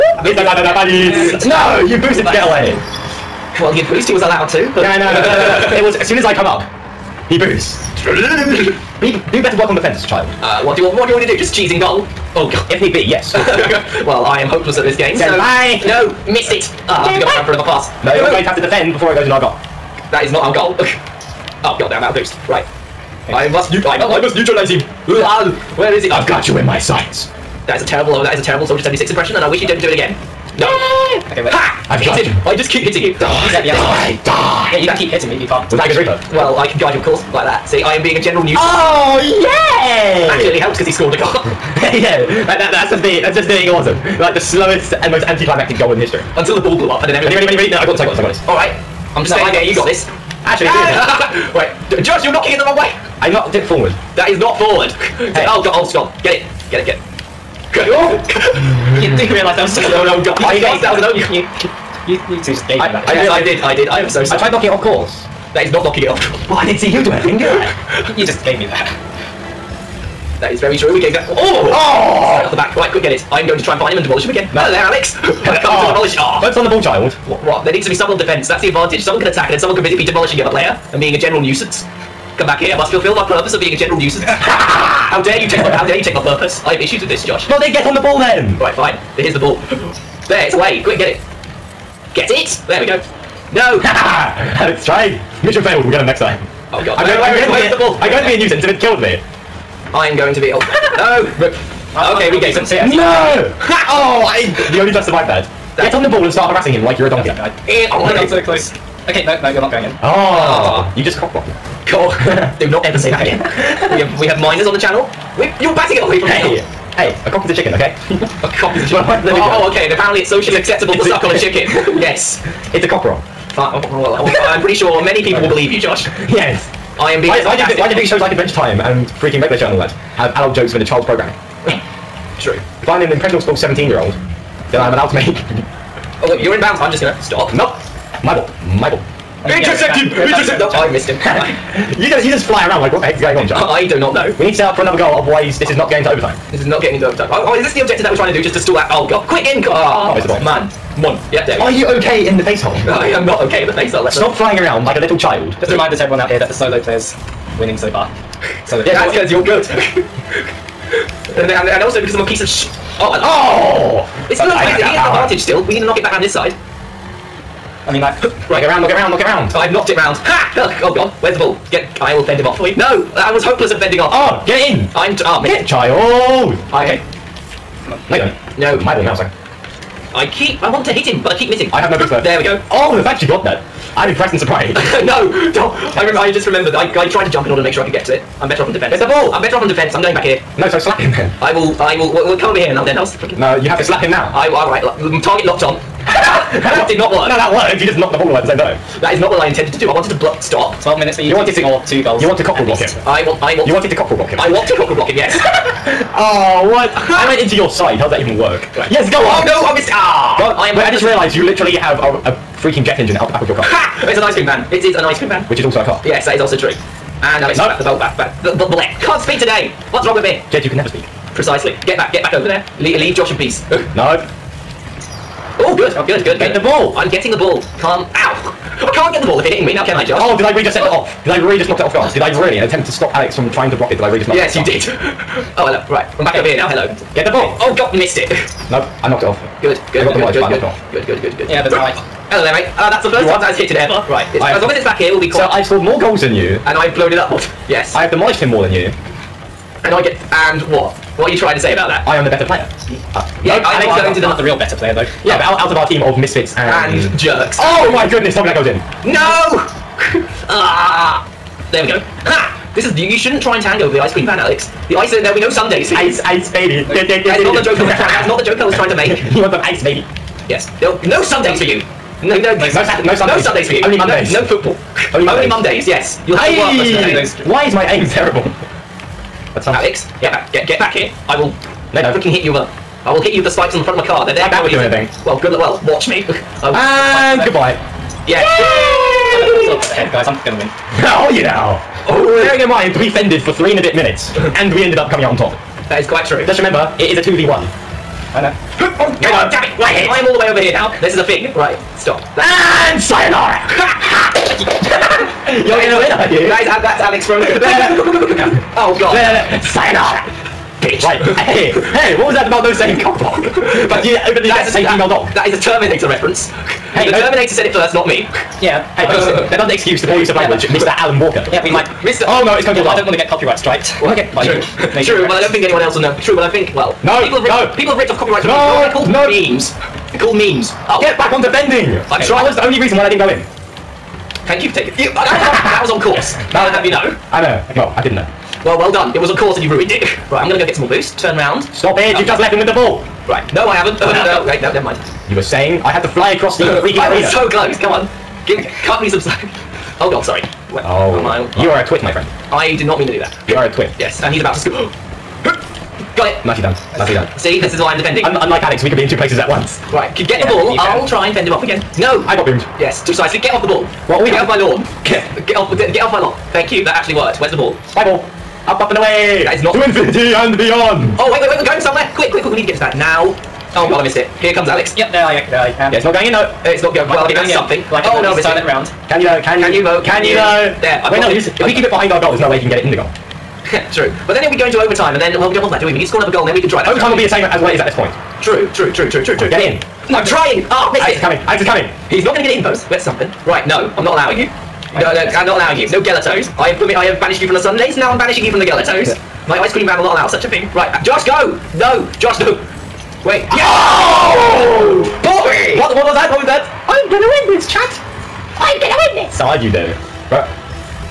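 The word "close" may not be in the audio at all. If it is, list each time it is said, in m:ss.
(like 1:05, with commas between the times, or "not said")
1:48, 5:47.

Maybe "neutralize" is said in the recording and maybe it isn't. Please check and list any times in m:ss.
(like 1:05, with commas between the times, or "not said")
0:24.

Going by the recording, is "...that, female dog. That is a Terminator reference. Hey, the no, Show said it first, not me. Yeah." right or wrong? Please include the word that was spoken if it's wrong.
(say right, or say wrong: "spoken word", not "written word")
wrong: "Terminator", not "Show".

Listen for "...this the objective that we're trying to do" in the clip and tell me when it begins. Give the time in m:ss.
2:27.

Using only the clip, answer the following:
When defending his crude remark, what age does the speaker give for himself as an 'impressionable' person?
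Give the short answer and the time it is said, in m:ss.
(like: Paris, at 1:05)
17, at 2:13.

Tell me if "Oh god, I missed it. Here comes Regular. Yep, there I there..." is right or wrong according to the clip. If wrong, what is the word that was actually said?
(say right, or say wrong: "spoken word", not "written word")
wrong: "Alex", not "Regular".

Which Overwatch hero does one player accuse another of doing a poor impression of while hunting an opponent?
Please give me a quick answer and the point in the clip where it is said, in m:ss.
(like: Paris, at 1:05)
Soldier 76, at 0:28.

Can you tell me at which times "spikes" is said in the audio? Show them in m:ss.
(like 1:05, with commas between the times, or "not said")
4:43.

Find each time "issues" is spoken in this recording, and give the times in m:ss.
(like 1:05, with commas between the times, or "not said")
1:26.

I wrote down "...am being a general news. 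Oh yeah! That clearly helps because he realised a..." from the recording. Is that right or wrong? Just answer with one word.
wrong.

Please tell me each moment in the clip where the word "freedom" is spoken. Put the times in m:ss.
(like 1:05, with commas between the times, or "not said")
not said.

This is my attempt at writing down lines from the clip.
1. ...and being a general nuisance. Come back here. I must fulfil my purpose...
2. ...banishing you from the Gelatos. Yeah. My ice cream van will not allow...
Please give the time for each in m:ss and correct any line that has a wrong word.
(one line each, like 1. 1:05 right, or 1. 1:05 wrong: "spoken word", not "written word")
1. 1:20 right
2. 6:38 right.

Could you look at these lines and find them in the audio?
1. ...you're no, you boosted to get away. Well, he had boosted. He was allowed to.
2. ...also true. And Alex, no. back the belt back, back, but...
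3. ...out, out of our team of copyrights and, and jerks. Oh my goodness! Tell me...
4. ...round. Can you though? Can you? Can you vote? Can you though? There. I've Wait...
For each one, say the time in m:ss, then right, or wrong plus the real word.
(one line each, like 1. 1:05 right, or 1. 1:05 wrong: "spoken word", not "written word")
1. 0:00 right
2. 3:36 right
3. 4:15 wrong: "misfits", not "copyrights"
4. 6:18 right.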